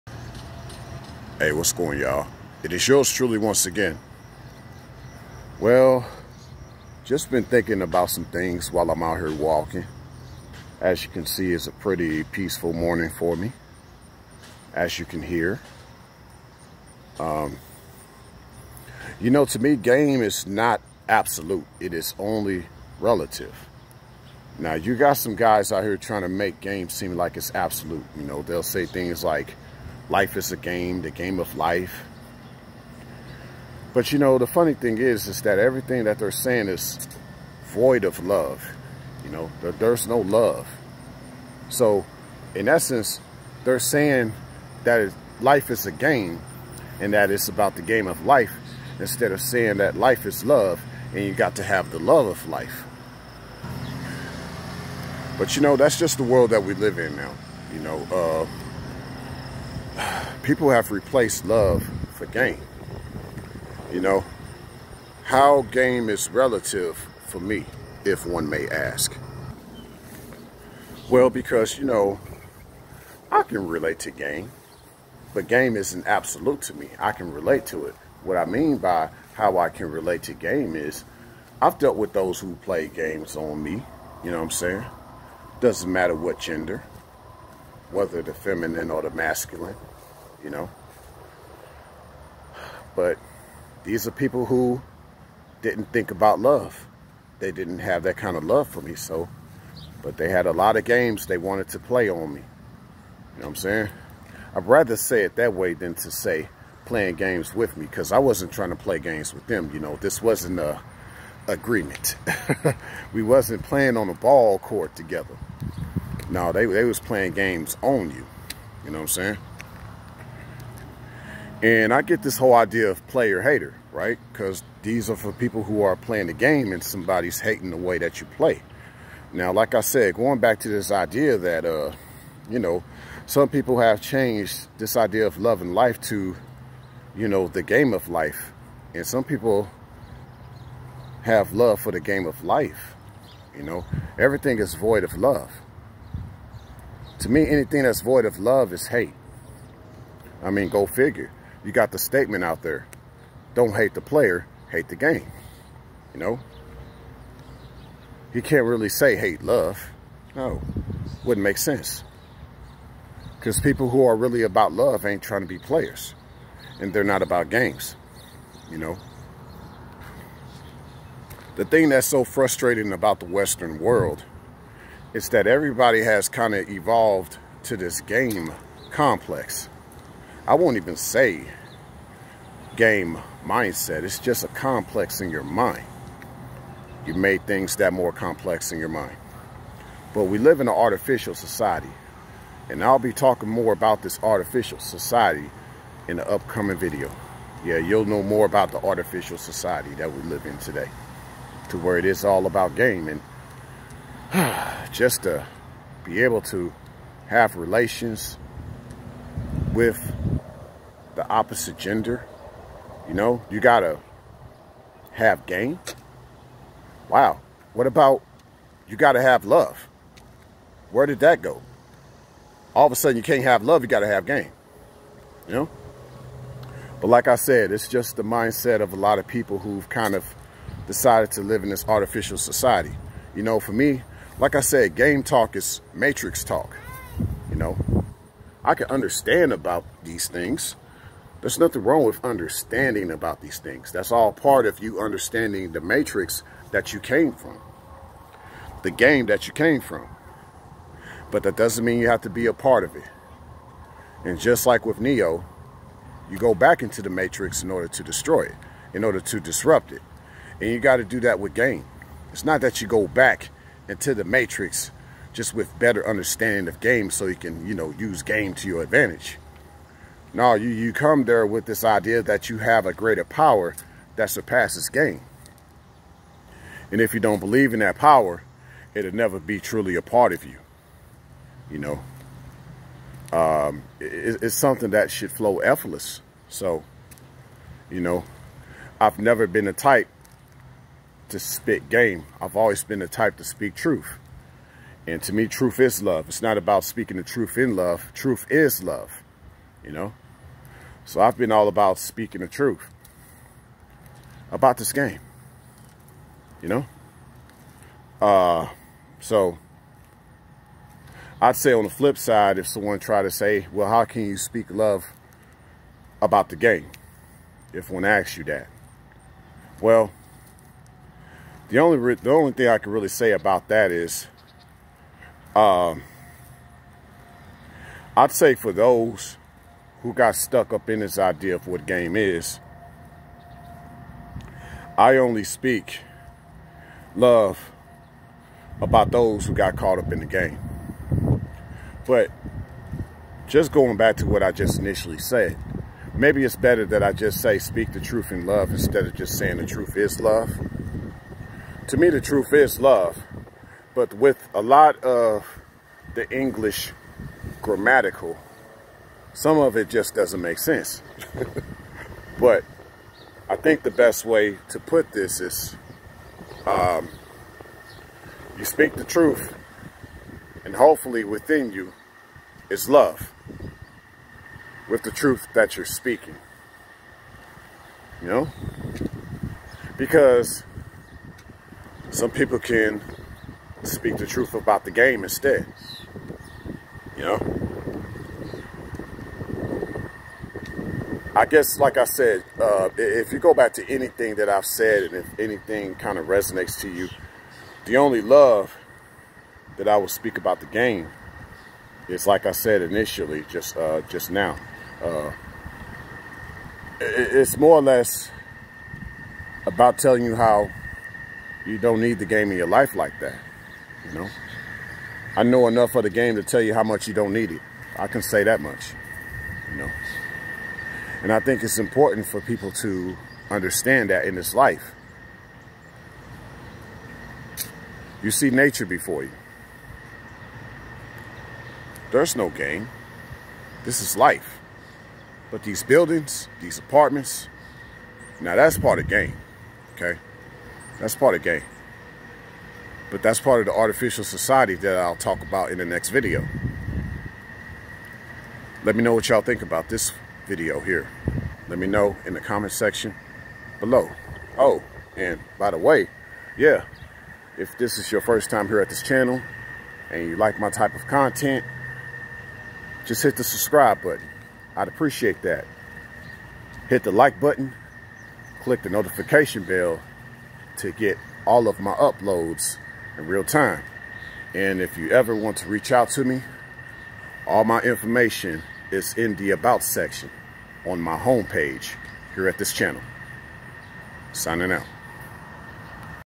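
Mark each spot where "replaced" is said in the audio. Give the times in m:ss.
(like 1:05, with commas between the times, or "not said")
1:00.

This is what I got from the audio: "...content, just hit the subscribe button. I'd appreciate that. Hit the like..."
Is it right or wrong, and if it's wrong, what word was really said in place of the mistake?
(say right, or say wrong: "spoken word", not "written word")
right.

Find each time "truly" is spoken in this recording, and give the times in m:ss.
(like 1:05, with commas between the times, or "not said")
0:03, 4:39.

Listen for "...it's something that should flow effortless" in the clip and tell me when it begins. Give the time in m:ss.
4:44.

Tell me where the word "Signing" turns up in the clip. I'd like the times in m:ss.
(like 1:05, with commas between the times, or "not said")
8:04.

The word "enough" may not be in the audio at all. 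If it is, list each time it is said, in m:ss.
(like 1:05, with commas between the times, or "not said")
6:55.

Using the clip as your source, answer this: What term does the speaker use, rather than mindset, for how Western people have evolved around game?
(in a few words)
Game complex.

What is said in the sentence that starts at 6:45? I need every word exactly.
Uh, it's more or less about telling you how you don't need the game in your life like that.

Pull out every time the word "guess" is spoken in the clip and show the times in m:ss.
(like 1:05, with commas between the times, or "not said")
6:31.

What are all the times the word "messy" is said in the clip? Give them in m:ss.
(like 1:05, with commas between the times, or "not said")
not said.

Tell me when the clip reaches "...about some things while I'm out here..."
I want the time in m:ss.
0:07.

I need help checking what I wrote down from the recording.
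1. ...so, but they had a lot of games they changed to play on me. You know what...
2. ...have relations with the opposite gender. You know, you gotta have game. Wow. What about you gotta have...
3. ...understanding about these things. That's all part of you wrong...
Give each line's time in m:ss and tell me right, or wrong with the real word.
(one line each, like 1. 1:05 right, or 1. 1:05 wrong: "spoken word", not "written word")
1. 1:38 wrong: "wanted", not "changed"
2. 3:27 right
3. 4:02 wrong: "understanding", not "wrong".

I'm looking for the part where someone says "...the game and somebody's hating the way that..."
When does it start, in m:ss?
2:06.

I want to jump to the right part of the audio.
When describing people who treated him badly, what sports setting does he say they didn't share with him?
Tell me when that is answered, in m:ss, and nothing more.
1:53.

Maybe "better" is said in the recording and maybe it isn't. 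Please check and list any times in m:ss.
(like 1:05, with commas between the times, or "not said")
4:25, 5:46.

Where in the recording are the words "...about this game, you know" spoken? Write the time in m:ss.
5:04.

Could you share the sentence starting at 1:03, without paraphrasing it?
You know, how game is relative for me, if one may ask.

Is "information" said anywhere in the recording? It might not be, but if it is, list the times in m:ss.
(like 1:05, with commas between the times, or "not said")
7:57.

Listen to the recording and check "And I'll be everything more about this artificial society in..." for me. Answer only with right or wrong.
wrong.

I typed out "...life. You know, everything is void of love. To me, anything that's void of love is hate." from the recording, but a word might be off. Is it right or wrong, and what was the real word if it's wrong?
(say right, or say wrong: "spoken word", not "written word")
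right.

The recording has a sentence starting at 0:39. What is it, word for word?
You know, there, there's no love.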